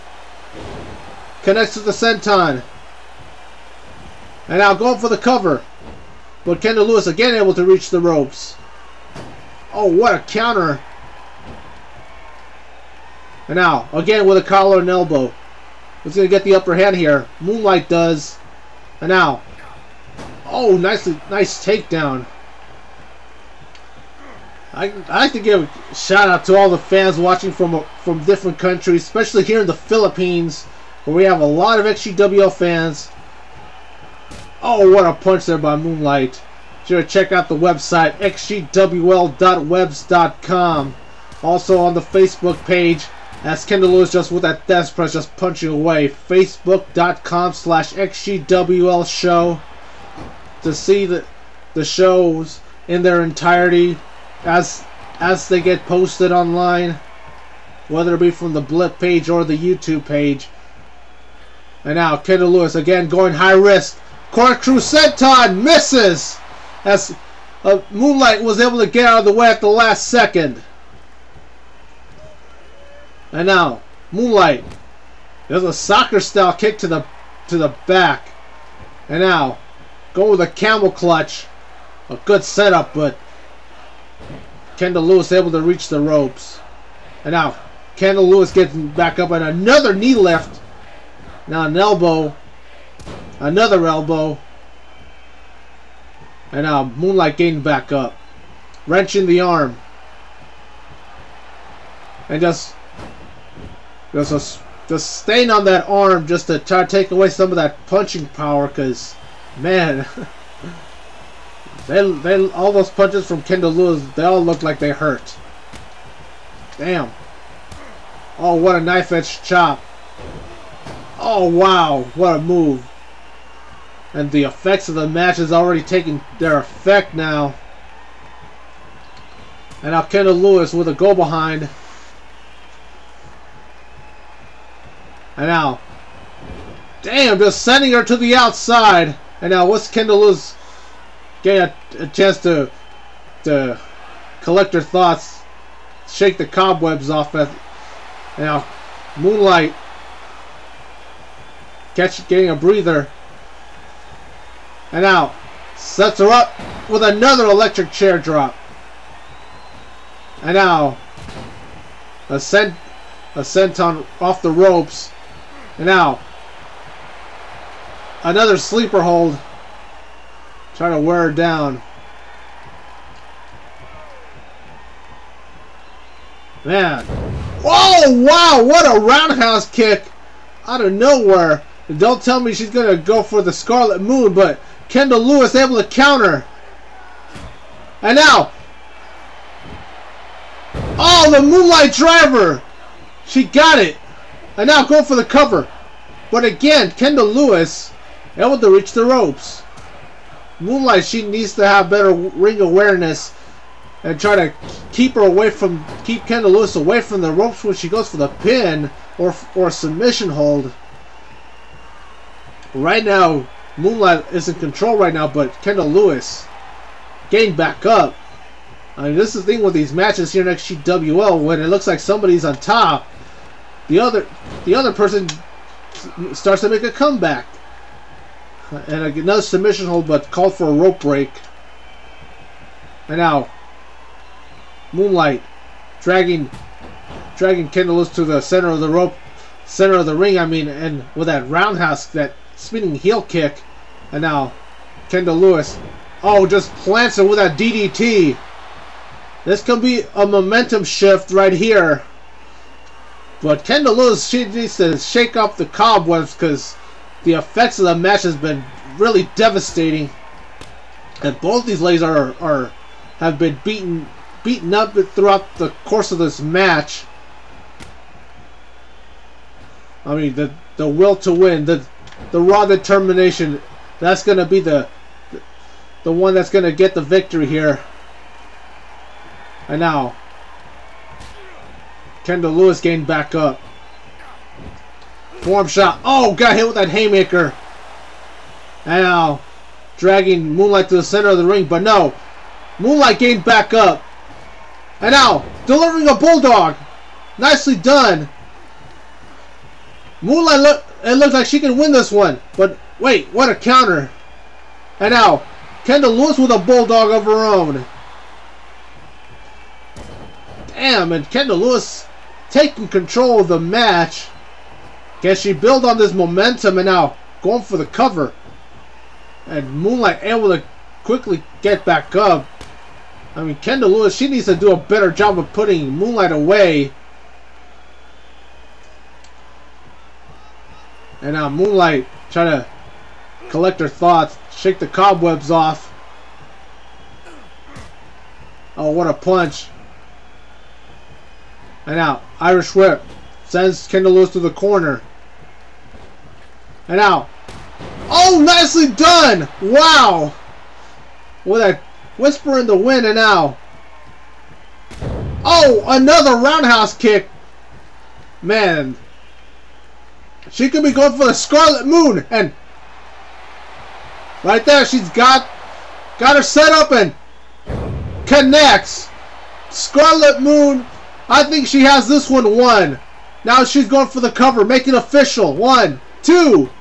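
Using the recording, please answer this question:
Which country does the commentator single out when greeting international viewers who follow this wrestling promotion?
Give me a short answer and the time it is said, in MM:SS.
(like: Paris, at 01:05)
Philippines, at 00:29.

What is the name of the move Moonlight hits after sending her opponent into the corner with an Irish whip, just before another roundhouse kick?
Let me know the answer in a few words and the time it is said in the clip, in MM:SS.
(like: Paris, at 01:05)
Whisper in the Wind, at 05:52.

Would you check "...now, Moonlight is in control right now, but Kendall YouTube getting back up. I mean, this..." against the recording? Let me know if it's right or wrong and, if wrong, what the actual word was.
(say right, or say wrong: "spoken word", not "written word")
wrong: "Lewis", not "YouTube".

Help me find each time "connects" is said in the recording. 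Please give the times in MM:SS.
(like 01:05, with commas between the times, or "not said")
00:01, 06:08.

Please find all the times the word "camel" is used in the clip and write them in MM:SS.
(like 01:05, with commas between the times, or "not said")
01:20.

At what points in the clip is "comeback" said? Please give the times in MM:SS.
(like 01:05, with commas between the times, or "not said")
03:46.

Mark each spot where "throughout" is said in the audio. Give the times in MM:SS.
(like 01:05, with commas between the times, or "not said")
04:24.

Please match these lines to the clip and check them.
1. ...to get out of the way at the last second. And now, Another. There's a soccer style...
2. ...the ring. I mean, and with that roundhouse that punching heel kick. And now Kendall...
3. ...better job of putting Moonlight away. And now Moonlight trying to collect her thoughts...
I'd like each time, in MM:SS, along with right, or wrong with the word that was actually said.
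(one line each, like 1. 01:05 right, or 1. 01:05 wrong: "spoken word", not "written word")
1. 01:08 wrong: "Moonlight", not "Another"
2. 04:00 wrong: "spinning", not "punching"
3. 05:24 right.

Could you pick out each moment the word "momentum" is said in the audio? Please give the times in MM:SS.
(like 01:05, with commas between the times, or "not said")
04:10, 05:16.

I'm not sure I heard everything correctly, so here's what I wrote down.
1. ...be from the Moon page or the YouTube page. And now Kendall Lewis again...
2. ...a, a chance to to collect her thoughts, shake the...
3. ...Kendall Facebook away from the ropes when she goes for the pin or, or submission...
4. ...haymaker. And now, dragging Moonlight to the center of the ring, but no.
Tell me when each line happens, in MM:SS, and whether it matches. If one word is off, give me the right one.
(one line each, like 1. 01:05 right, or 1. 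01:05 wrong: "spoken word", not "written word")
1. 00:58 wrong: "Blip", not "Moon"
2. 02:21 right
3. 03:26 wrong: "Lewis", not "Facebook"
4. 04:46 right.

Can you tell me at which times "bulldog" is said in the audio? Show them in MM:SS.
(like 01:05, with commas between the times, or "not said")
04:56, 05:06.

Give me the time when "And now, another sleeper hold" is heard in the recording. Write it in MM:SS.
02:45.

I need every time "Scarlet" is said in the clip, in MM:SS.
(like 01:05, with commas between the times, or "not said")
03:03, 06:01, 06:09.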